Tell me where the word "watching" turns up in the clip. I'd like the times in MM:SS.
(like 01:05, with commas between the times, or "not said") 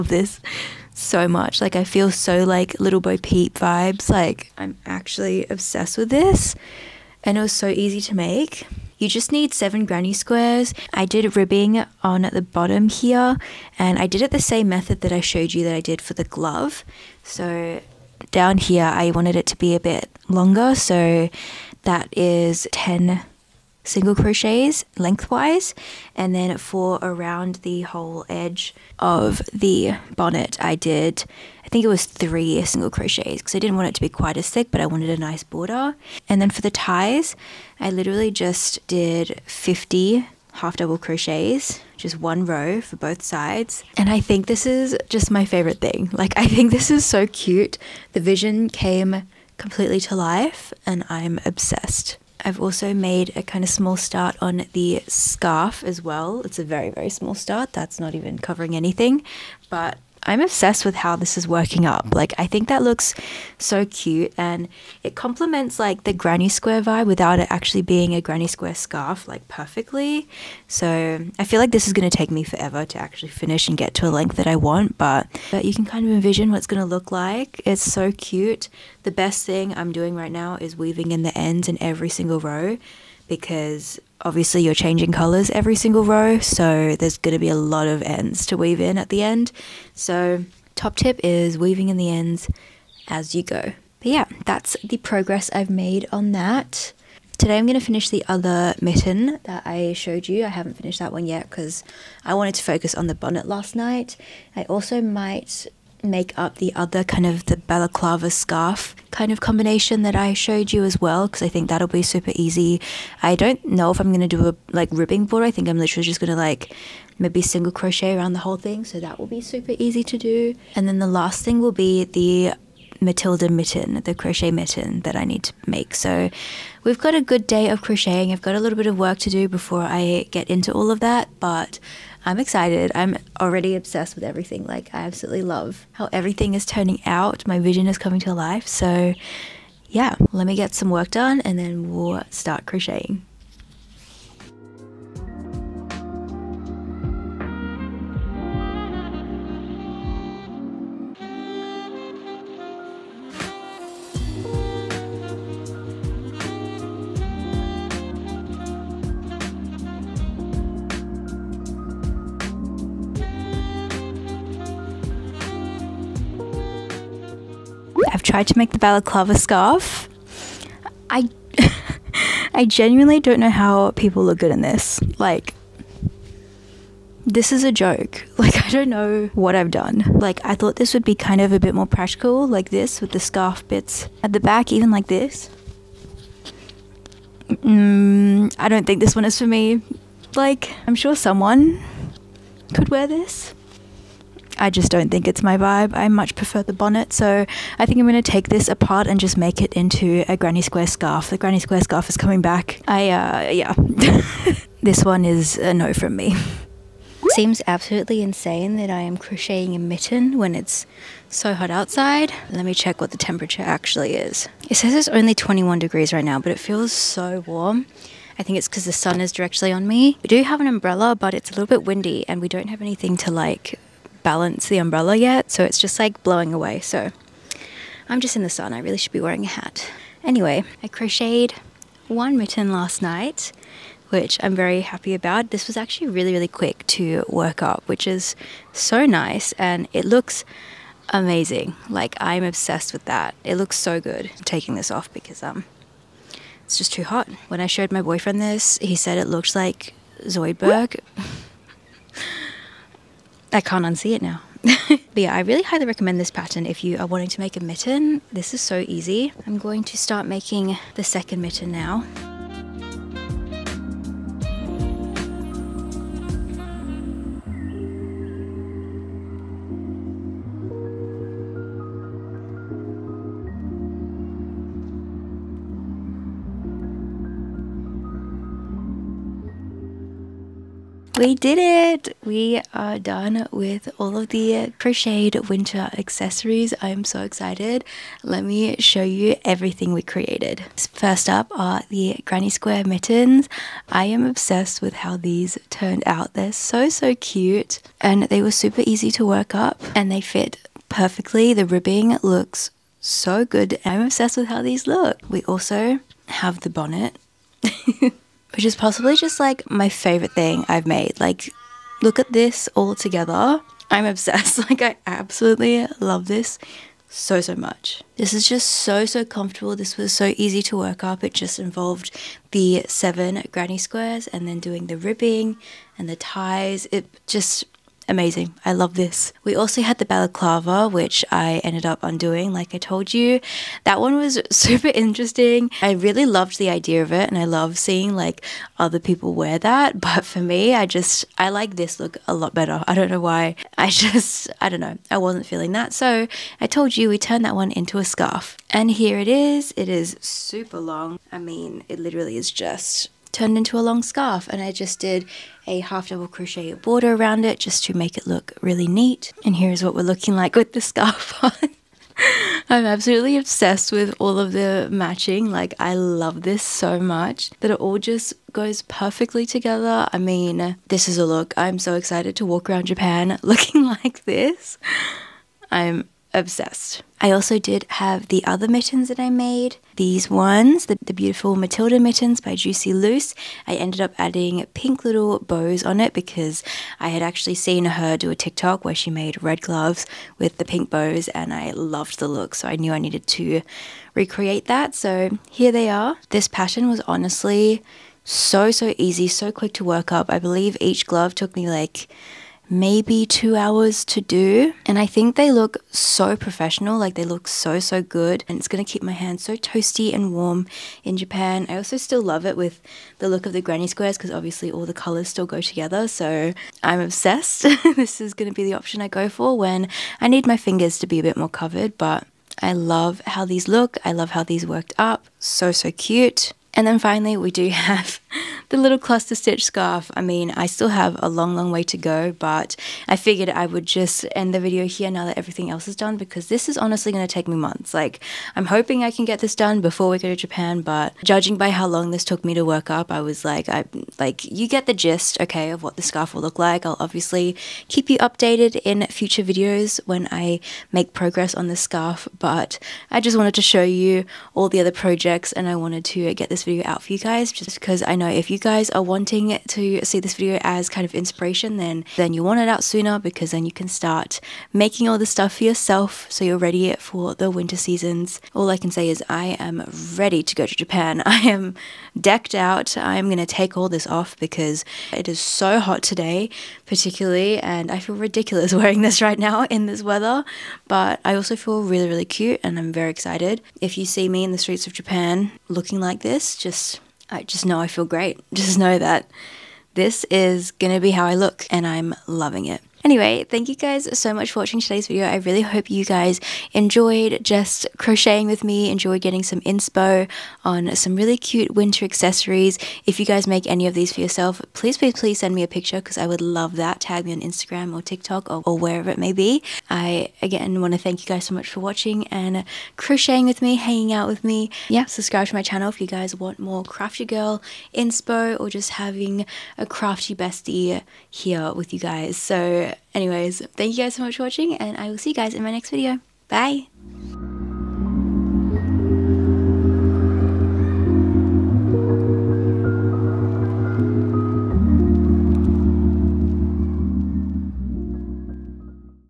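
08:14, 08:31, 08:44.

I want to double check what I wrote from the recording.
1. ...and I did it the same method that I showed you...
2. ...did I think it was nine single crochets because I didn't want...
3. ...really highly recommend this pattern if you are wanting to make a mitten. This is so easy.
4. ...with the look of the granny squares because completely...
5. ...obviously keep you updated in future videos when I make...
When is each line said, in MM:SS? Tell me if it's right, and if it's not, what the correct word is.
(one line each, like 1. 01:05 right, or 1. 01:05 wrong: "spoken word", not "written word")
1. 00:13 right
2. 00:30 wrong: "three", not "nine"
3. 04:15 right
4. 06:52 wrong: "obviously", not "completely"
5. 07:26 right.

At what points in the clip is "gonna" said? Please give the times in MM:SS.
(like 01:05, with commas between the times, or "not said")
06:48, 06:58.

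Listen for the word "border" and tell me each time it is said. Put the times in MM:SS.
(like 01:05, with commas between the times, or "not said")
00:35, 05:56.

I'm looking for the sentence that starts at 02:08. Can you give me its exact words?
I've got a little bit of work to do before I get into all of that, but I'm excited.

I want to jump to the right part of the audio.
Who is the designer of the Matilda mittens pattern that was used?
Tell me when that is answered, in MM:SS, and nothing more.
06:22.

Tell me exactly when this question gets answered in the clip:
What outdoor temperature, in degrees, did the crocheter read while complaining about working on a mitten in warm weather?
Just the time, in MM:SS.
03:35.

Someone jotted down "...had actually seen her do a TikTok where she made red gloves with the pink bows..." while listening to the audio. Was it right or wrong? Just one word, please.
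right.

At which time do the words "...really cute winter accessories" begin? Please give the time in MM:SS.
08:21.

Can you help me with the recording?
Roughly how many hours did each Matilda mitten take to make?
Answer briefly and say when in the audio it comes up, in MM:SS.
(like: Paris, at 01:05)
2, at 06:43.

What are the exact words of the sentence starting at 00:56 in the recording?
It's a very, very small start.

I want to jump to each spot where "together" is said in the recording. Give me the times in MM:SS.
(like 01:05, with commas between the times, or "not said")
05:12, 06:09, 06:55.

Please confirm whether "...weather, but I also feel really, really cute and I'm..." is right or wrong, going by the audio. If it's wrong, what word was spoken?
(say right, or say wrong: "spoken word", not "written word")
right.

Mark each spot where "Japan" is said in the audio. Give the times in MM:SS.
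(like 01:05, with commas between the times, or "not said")
06:12, 06:51, 07:20, 07:50, 08:04.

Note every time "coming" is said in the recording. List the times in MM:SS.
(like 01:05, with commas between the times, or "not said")
02:17, 03:22.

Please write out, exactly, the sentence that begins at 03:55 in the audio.
This was actually really, really quick to work up, which is so nice and it looks amazing.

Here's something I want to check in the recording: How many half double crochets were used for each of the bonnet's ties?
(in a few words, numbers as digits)
50.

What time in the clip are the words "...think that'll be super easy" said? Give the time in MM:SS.
01:51.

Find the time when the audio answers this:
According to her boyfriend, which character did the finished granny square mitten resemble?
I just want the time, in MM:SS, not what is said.
04:10.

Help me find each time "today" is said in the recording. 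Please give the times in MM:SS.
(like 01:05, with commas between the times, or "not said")
01:37, 07:56, 08:14.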